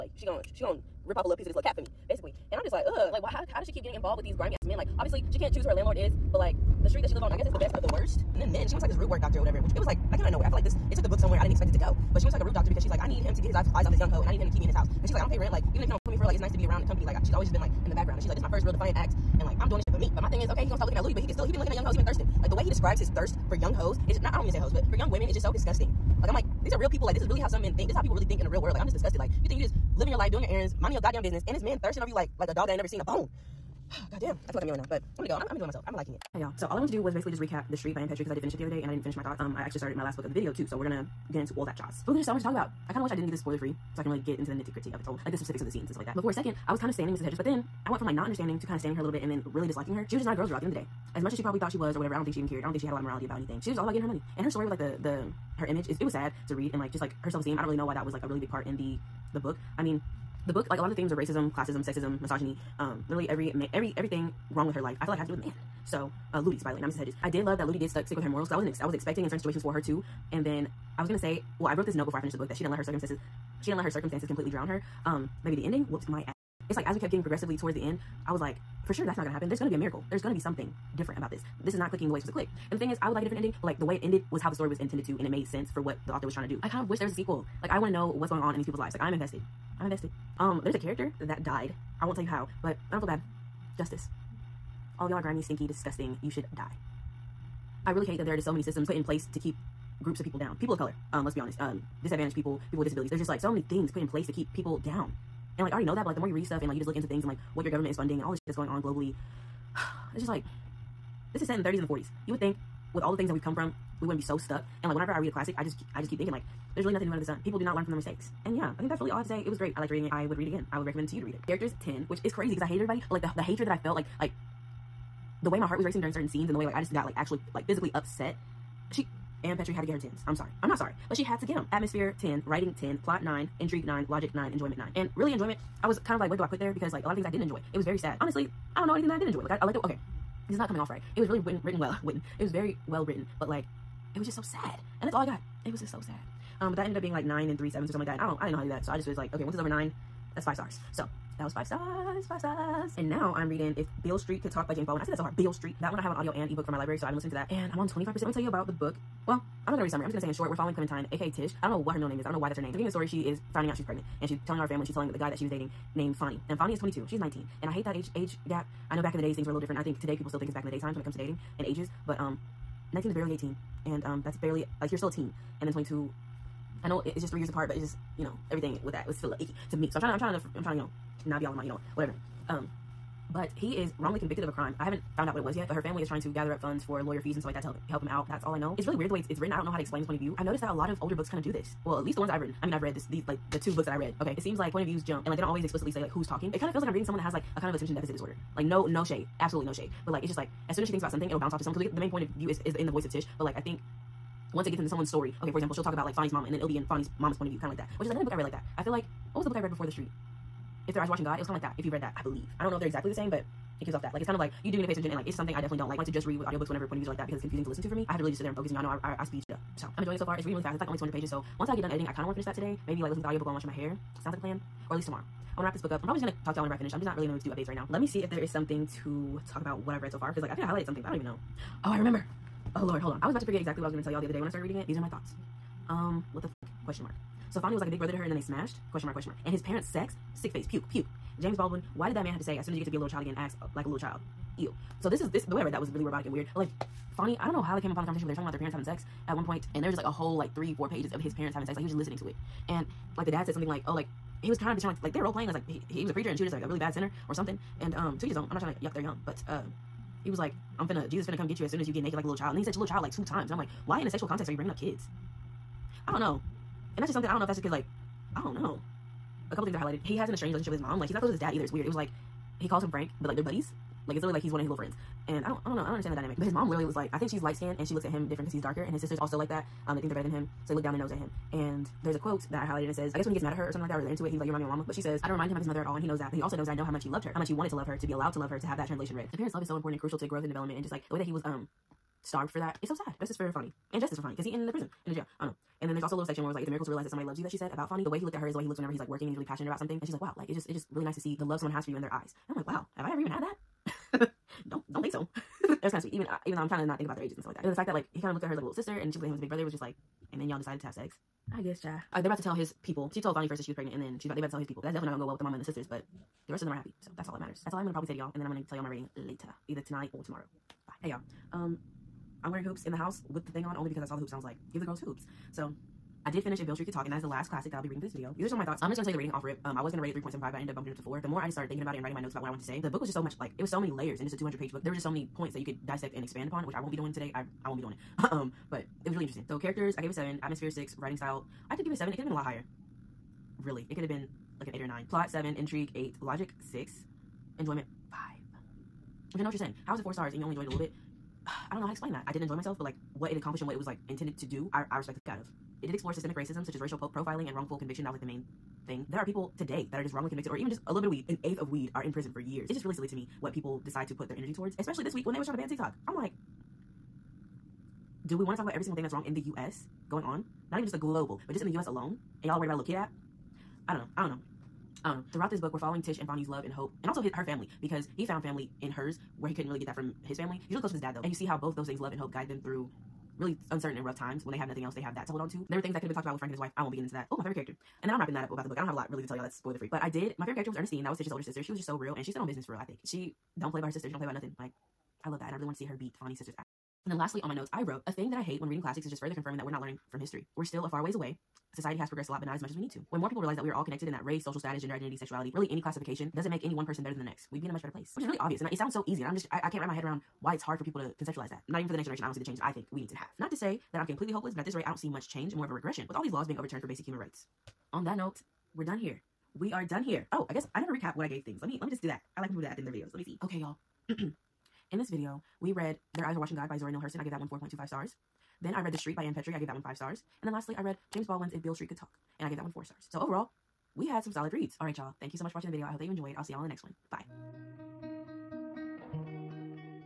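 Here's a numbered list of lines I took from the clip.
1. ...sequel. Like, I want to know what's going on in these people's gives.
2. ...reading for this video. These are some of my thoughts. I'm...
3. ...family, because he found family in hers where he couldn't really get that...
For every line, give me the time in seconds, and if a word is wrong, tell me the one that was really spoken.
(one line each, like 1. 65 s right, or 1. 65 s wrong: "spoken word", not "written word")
1. 87 s wrong: "lives", not "gives"
2. 327 s right
3. 377 s right.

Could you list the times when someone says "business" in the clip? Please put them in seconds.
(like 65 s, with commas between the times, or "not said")
31 s, 392 s.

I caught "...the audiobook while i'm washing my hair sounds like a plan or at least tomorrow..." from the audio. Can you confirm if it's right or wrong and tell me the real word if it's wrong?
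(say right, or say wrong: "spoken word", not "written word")
right.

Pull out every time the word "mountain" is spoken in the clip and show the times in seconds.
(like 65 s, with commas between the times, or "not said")
not said.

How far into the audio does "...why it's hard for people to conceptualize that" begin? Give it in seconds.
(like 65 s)
410 s.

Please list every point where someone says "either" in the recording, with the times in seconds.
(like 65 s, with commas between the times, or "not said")
271 s, 319 s.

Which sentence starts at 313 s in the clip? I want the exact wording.
She told Fonny first that she was pregnant, and then she's about they about to tell his people.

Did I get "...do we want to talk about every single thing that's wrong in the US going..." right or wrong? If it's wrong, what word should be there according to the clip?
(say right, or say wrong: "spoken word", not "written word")
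right.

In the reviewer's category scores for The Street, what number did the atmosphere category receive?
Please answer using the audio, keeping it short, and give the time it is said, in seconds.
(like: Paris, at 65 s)
10, at 131 s.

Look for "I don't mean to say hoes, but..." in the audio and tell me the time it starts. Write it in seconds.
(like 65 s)
24 s.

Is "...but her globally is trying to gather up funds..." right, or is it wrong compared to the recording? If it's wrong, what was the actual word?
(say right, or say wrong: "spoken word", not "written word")
wrong: "family", not "globally".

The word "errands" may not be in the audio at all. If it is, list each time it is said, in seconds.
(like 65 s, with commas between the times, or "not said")
30 s.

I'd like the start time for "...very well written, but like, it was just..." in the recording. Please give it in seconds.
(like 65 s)
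142 s.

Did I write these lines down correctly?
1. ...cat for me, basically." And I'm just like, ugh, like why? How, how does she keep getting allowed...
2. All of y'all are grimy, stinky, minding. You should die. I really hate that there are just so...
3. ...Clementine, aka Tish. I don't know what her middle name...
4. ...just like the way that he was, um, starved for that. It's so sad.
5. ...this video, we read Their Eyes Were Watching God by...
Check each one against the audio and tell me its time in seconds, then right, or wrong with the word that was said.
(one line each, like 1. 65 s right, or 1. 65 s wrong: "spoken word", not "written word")
1. 1 s wrong: "involved", not "allowed"
2. 94 s wrong: "disgusting", not "minding"
3. 160 s right
4. 290 s right
5. 424 s right.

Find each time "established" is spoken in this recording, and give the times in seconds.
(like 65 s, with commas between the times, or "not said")
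not said.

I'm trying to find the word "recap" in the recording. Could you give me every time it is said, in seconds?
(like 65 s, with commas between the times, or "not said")
37 s, 420 s.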